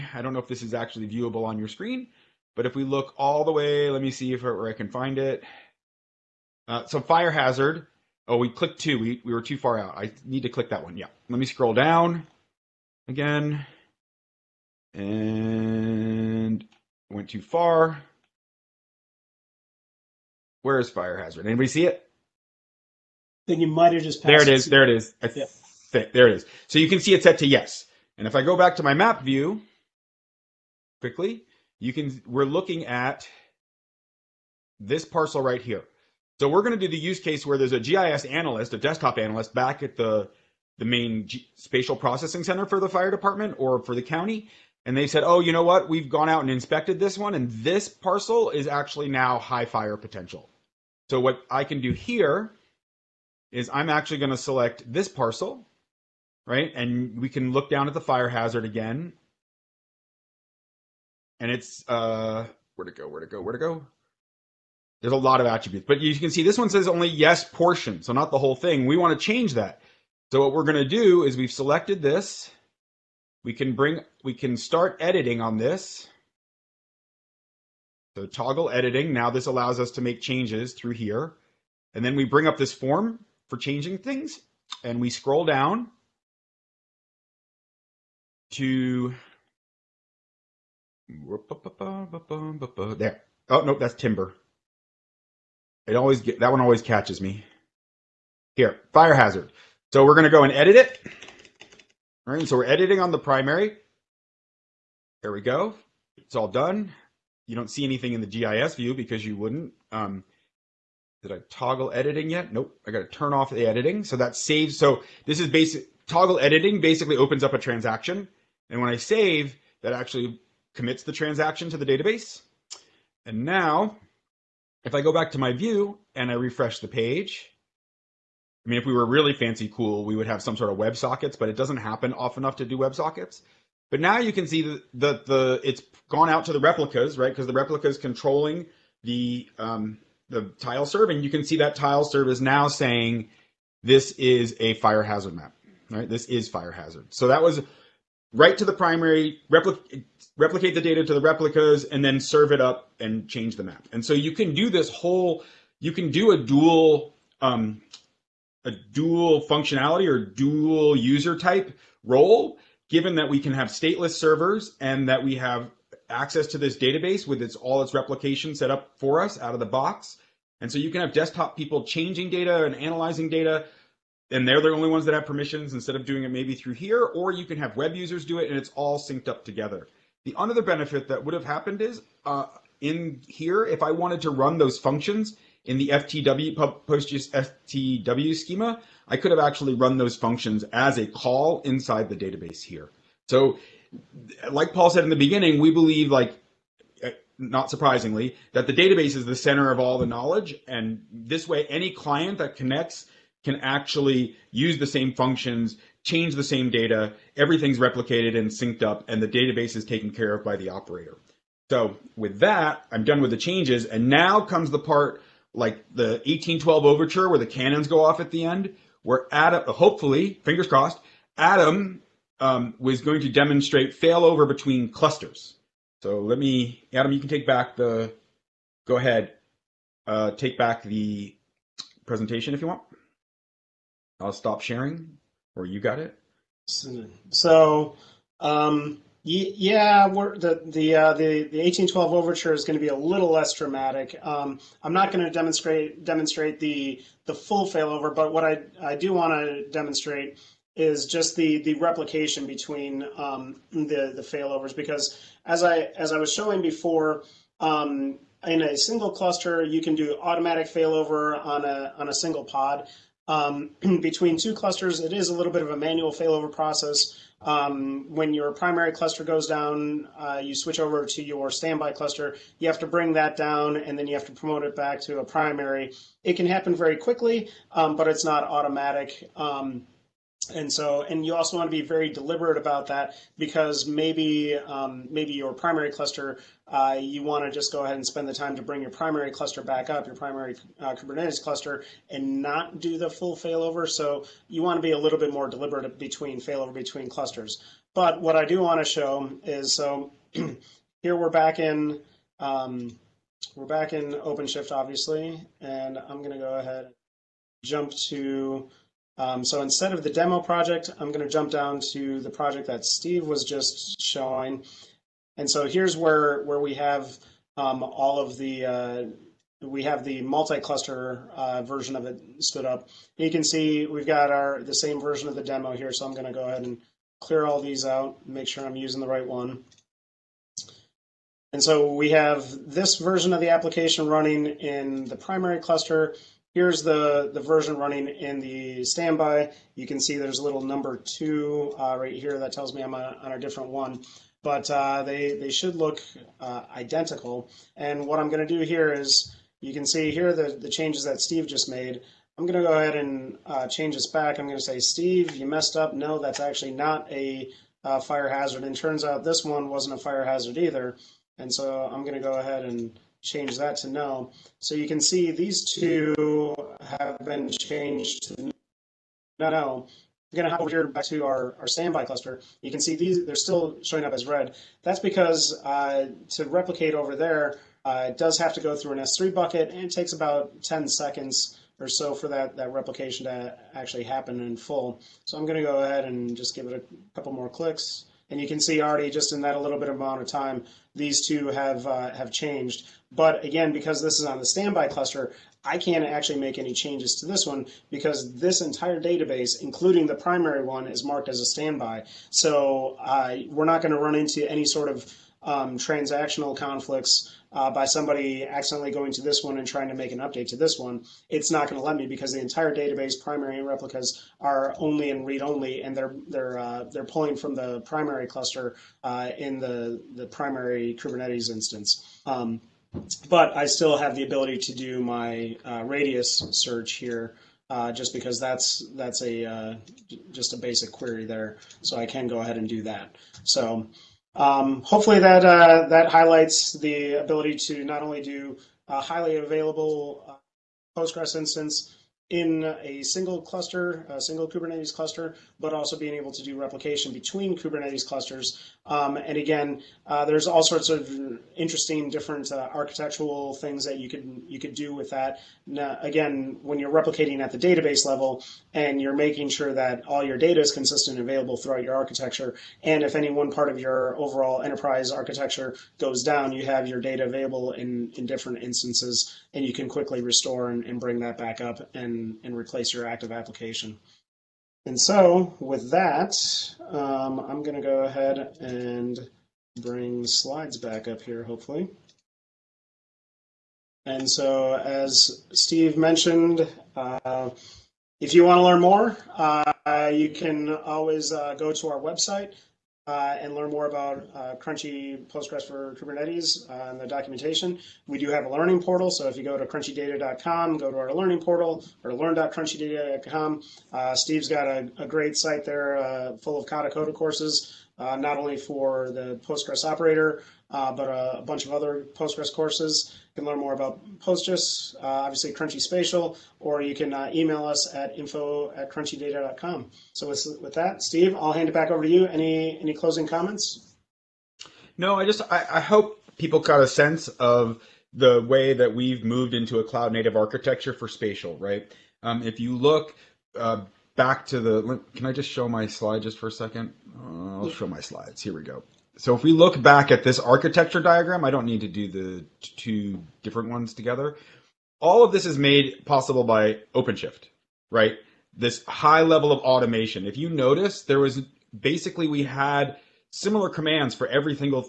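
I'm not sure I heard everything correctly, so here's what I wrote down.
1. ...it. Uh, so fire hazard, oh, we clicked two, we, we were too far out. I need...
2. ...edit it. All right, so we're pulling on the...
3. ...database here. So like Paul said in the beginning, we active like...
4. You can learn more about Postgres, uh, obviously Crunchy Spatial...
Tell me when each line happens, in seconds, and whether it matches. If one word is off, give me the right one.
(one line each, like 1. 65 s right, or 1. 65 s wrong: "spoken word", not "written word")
1. 5 s right
2. 100 s wrong: "editing", not "pulling"
3. 192 s wrong: "believe", not "active"
4. 513 s right.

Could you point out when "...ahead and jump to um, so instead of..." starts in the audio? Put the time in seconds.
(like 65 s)
306 s.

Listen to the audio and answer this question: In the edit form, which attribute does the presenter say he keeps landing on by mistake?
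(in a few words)
Timber.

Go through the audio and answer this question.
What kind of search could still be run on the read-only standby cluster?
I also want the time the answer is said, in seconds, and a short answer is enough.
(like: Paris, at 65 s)
Radius search, at 425 s.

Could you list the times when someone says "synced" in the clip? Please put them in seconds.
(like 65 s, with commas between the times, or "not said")
178 s, 208 s.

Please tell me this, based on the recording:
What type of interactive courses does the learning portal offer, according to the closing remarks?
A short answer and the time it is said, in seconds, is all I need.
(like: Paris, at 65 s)
Katacoda courses, at 506 s.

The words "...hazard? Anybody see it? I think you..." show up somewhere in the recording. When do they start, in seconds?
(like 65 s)
21 s.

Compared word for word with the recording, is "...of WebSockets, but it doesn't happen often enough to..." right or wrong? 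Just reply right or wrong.
right.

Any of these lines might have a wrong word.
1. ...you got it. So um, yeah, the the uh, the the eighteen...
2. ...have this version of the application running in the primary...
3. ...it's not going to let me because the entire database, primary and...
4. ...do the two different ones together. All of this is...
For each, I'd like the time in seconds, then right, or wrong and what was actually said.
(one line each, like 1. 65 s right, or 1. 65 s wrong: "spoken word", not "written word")
1. 235 s right
2. 332 s right
3. 411 s right
4. 541 s right.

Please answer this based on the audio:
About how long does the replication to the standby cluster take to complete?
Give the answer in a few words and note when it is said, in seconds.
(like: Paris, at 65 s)
10 seconds, at 380 s.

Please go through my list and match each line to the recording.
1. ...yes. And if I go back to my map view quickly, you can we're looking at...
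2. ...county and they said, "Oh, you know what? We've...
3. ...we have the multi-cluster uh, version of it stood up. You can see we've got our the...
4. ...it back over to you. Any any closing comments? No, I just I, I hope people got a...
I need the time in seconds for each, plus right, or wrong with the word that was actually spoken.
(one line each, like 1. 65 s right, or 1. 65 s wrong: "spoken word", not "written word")
1. 27 s right
2. 44 s right
3. 319 s right
4. 521 s right.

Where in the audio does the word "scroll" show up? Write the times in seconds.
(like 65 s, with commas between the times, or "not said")
11 s, 85 s.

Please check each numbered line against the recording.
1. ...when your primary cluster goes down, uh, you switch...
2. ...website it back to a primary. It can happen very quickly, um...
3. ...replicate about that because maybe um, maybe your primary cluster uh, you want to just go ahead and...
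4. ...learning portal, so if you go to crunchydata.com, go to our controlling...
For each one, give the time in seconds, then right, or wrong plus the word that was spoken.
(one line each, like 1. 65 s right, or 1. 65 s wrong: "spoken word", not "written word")
1. 268 s right
2. 274 s wrong: "promote", not "website"
3. 282 s wrong: "deliberate", not "replicate"
4. 498 s wrong: "learning", not "controlling".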